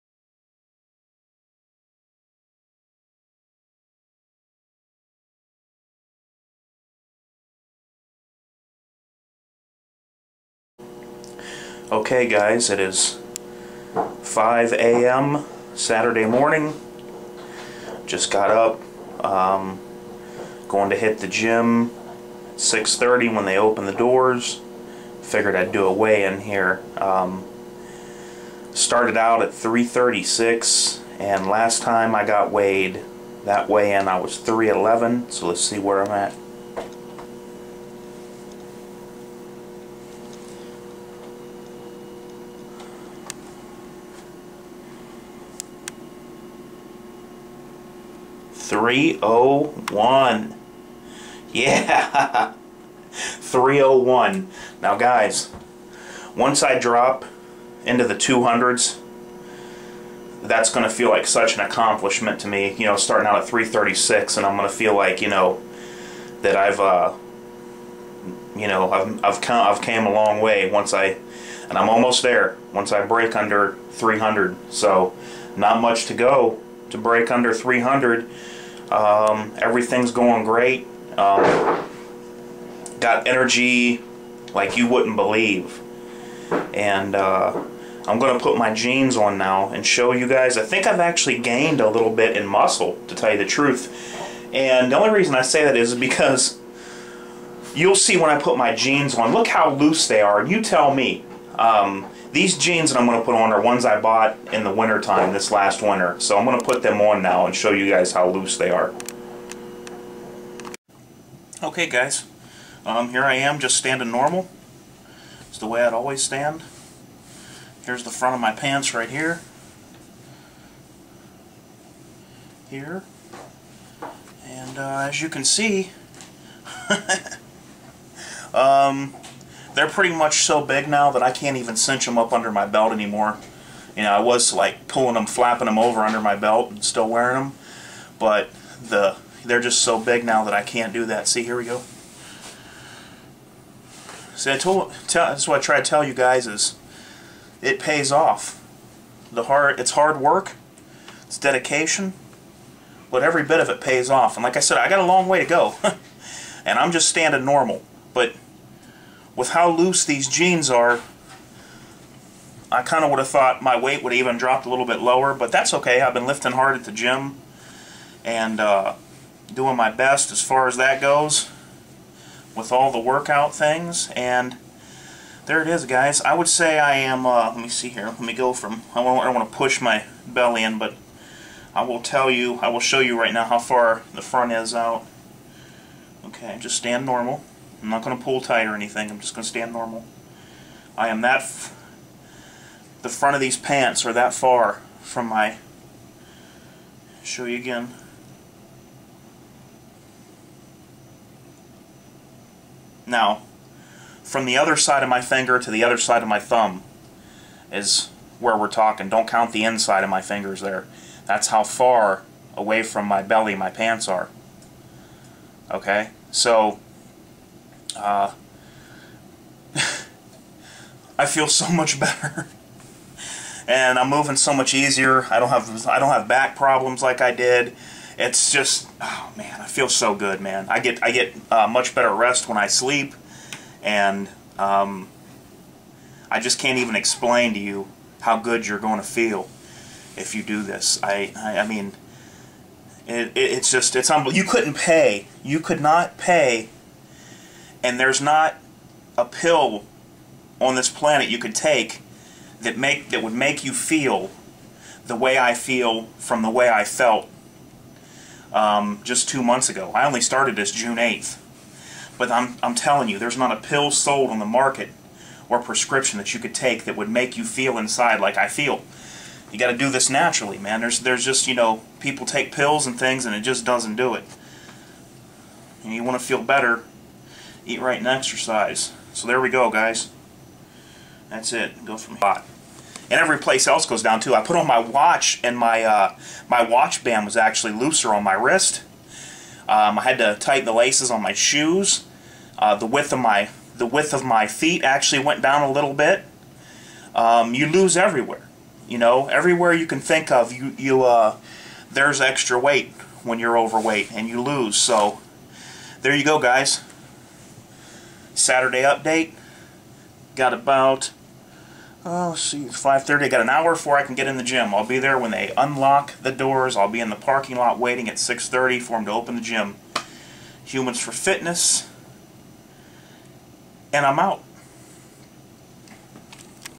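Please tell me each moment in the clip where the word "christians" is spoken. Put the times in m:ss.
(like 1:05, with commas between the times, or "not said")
not said.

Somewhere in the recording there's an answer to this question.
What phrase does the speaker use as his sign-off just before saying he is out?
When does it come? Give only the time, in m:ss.
5:20.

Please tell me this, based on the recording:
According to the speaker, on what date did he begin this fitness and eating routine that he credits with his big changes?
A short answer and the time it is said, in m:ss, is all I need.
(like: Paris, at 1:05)
June 8, at 4:20.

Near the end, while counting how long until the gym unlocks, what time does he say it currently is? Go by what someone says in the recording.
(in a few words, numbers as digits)
5:30.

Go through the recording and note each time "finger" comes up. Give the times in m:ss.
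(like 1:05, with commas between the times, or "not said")
3:25, 3:30.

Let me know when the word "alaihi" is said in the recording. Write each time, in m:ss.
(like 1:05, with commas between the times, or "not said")
not said.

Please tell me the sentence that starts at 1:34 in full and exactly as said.
And the only reason I say that is because you'll see when I put my jeans on, look how loose they are.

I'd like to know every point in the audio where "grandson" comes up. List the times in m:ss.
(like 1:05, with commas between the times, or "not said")
not said.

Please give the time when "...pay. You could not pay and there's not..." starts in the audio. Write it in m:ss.
4:04.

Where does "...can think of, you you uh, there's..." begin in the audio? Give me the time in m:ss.
4:59.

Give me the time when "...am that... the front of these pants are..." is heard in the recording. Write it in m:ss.
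3:11.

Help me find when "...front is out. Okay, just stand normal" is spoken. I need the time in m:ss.
3:04.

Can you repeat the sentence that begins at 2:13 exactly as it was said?
You know, I was like pulling them, flapping them over under my belt and still wearing them.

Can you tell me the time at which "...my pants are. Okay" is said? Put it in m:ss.
3:33.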